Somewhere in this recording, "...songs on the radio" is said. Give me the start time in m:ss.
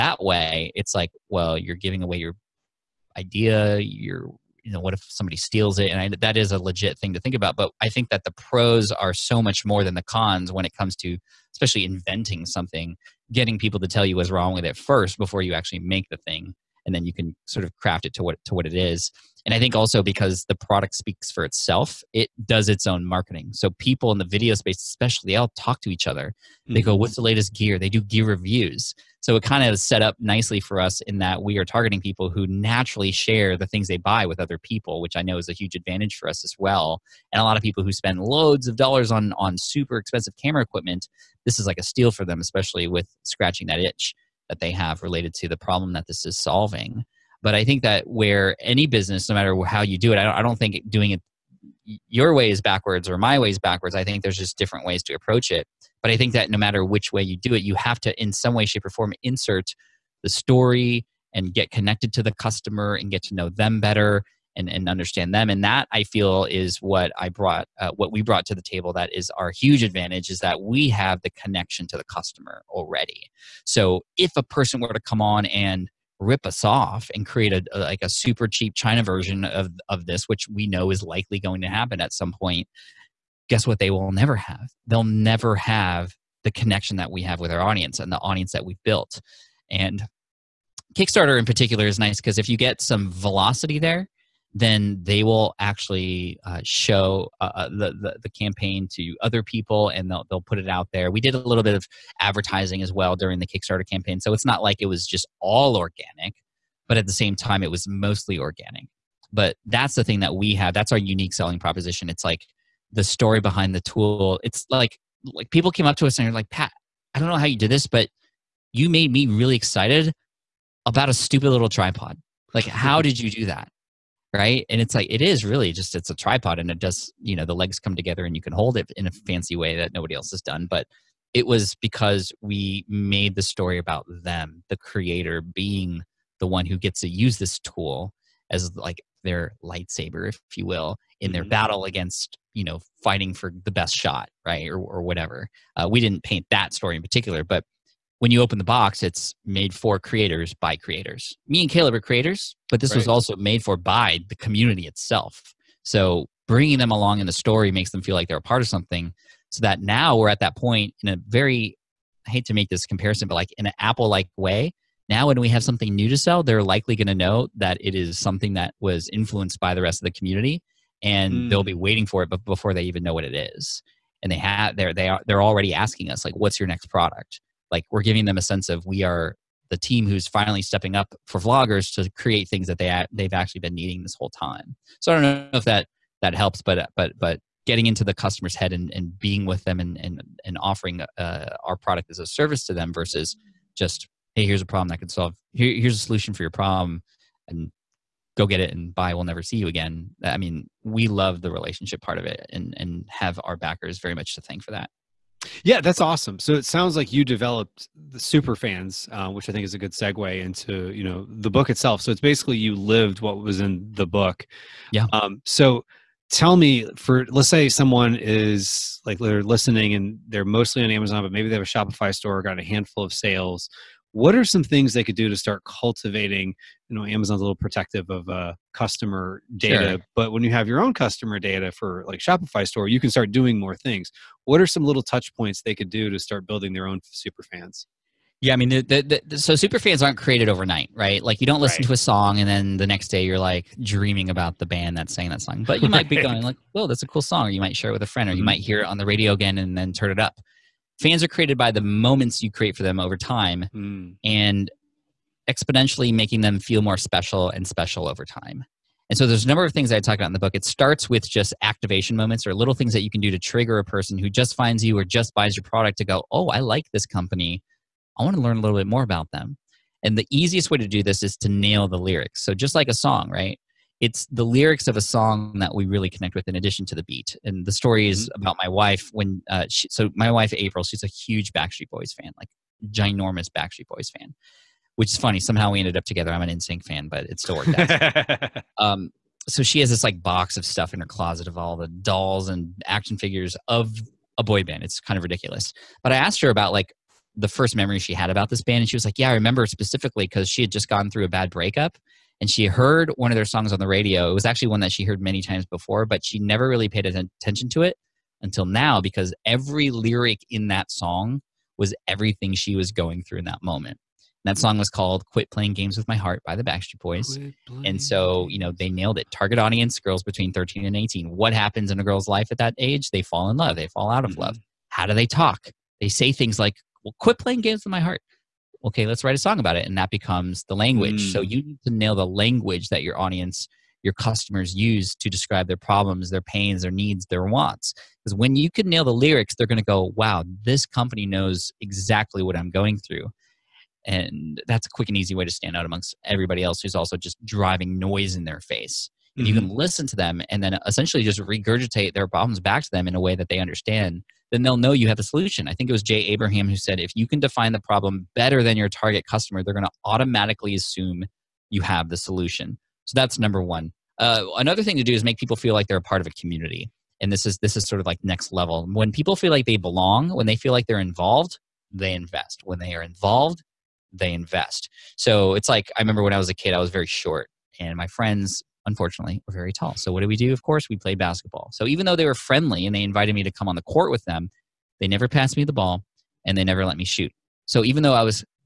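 5:03.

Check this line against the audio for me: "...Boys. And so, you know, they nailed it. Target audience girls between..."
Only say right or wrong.
right.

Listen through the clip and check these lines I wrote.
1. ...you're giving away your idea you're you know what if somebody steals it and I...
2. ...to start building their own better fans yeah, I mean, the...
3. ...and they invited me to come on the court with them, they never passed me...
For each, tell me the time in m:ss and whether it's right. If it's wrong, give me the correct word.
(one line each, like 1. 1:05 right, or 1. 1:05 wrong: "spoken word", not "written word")
1. 0:01 right
2. 3:56 wrong: "super", not "better"
3. 6:22 right.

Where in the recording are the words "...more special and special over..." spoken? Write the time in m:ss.
4:16.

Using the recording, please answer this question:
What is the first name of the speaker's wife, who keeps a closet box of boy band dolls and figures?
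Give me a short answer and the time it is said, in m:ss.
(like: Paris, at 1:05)
April, at 4:40.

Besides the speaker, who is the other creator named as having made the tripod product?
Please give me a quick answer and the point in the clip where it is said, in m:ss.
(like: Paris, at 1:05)
Caleb, at 2:31.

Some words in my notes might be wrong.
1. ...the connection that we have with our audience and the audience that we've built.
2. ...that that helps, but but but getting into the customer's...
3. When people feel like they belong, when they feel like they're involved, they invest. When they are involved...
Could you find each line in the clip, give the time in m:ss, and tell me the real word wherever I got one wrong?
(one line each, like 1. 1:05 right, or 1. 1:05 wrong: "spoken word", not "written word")
1. 1:26 right
2. 3:05 right
3. 6:08 right.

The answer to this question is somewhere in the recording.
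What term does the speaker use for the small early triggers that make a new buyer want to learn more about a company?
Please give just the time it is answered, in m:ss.
4:21.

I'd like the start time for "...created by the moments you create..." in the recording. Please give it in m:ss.
4:11.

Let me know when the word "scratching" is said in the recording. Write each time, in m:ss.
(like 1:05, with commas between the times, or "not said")
0:43.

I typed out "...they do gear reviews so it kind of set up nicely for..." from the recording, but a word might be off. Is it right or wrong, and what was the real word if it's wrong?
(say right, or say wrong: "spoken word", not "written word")
right.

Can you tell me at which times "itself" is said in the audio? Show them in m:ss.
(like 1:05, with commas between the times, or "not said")
0:21, 2:34, 3:31.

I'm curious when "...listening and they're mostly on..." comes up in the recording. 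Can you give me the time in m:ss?
3:39.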